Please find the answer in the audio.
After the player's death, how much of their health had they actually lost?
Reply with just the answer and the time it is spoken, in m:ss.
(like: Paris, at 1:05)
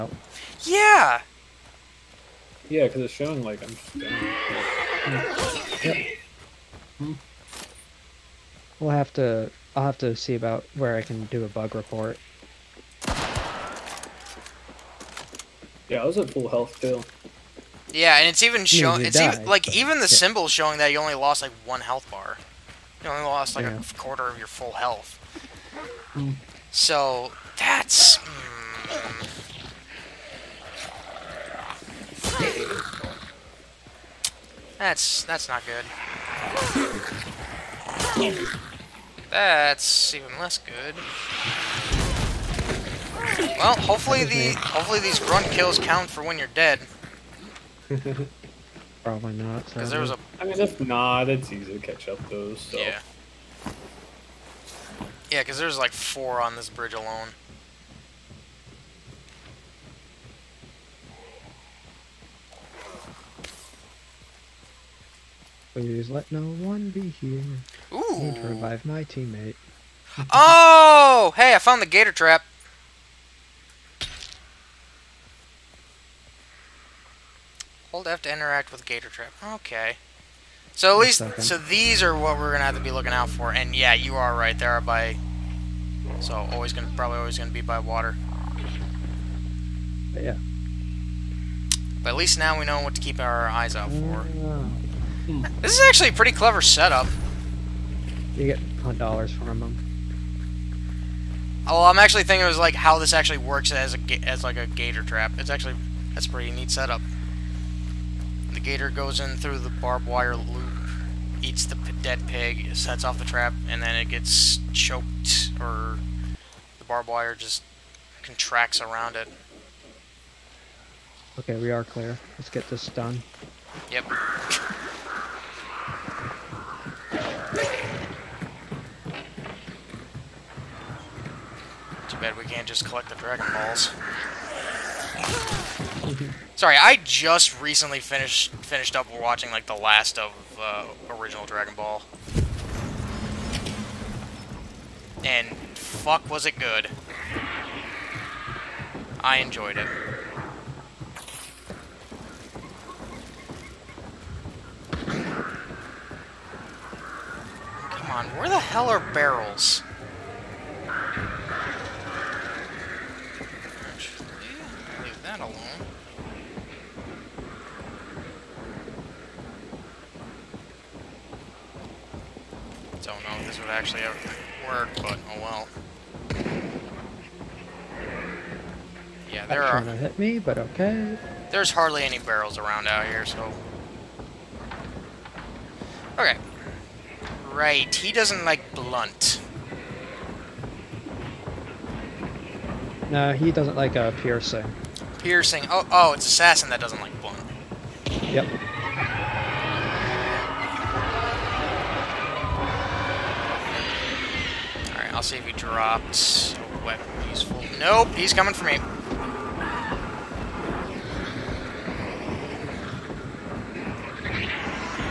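a quarter, at 0:23.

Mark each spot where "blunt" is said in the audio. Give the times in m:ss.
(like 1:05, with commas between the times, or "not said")
3:08, 3:17.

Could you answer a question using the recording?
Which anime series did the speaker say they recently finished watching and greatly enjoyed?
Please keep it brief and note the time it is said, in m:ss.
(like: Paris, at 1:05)
Dragon Ball, at 2:21.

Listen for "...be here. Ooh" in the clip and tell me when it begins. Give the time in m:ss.
1:06.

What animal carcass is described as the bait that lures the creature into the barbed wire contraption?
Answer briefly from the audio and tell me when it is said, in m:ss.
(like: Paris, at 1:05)
dead pig, at 1:52.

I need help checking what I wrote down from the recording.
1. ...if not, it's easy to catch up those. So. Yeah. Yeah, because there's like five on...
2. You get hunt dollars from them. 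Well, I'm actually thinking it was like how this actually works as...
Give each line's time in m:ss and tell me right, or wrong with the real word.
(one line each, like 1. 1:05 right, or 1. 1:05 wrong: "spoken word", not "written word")
1. 0:50 wrong: "four", not "five"
2. 1:38 right.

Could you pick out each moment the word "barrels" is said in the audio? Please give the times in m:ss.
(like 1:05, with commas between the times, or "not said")
2:39, 3:02.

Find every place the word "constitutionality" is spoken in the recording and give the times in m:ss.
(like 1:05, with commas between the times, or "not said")
not said.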